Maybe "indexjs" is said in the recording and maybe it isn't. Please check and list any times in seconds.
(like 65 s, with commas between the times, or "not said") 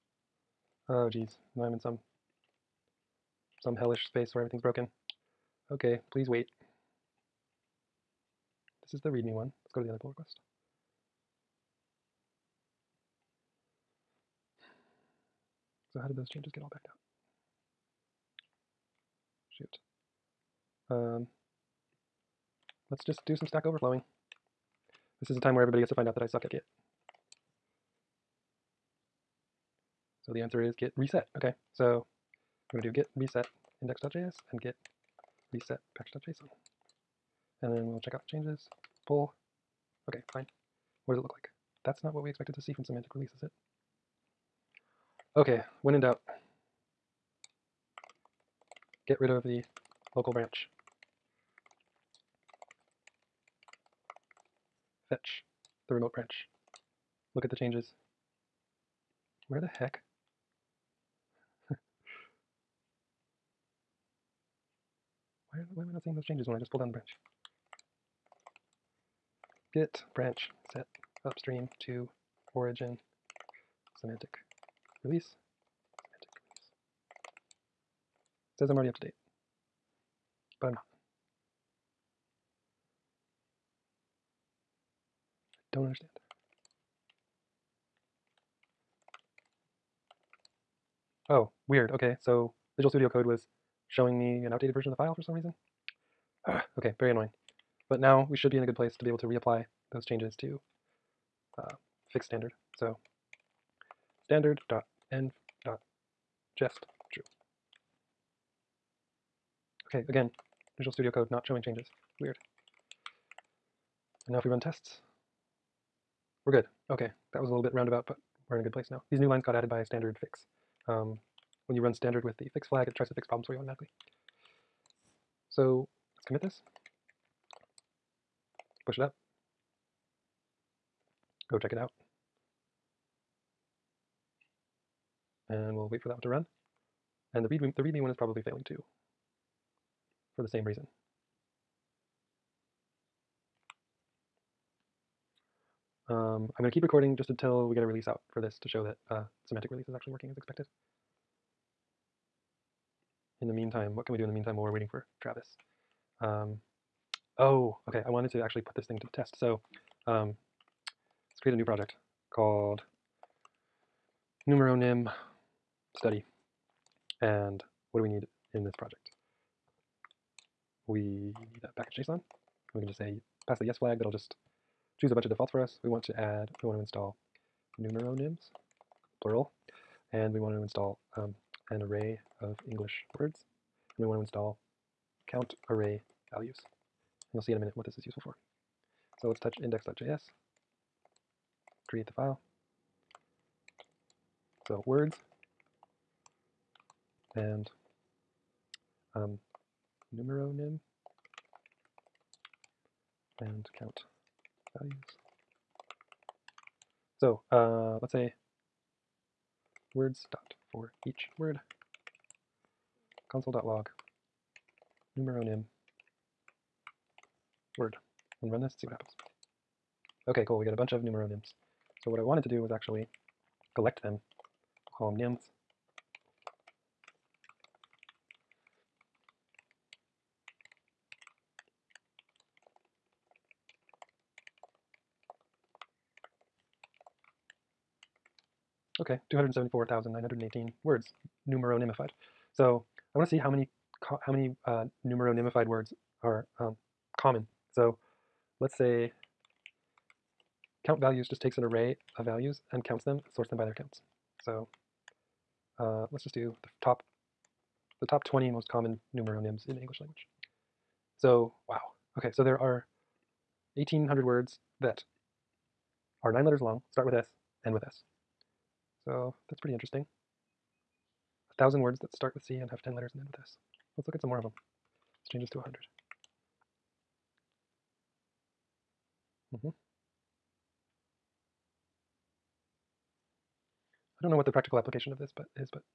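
33 s, 189 s.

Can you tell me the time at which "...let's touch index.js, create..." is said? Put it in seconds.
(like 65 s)
189 s.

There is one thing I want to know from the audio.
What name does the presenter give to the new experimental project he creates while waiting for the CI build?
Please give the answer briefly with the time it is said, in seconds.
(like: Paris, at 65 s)
numeronym study, at 164 s.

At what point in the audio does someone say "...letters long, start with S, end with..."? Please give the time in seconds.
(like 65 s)
266 s.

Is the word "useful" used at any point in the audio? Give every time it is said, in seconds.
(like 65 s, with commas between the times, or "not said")
188 s.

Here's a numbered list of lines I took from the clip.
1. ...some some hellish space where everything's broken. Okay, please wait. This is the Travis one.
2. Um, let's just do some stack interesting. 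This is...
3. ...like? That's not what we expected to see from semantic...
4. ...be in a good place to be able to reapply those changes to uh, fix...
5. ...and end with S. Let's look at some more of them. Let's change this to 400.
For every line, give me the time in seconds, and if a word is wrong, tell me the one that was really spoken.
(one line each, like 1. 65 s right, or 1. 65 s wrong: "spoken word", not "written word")
1. 1 s wrong: "README", not "Travis"
2. 20 s wrong: "overflowing", not "interesting"
3. 41 s right
4. 98 s right
5. 273 s wrong: "100", not "400".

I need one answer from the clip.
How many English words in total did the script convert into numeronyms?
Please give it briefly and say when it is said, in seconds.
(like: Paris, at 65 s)
274,918, at 239 s.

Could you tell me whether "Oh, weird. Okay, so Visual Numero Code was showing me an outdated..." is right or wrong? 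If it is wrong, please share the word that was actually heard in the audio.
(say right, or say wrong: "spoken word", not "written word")
wrong: "Studio", not "Numero".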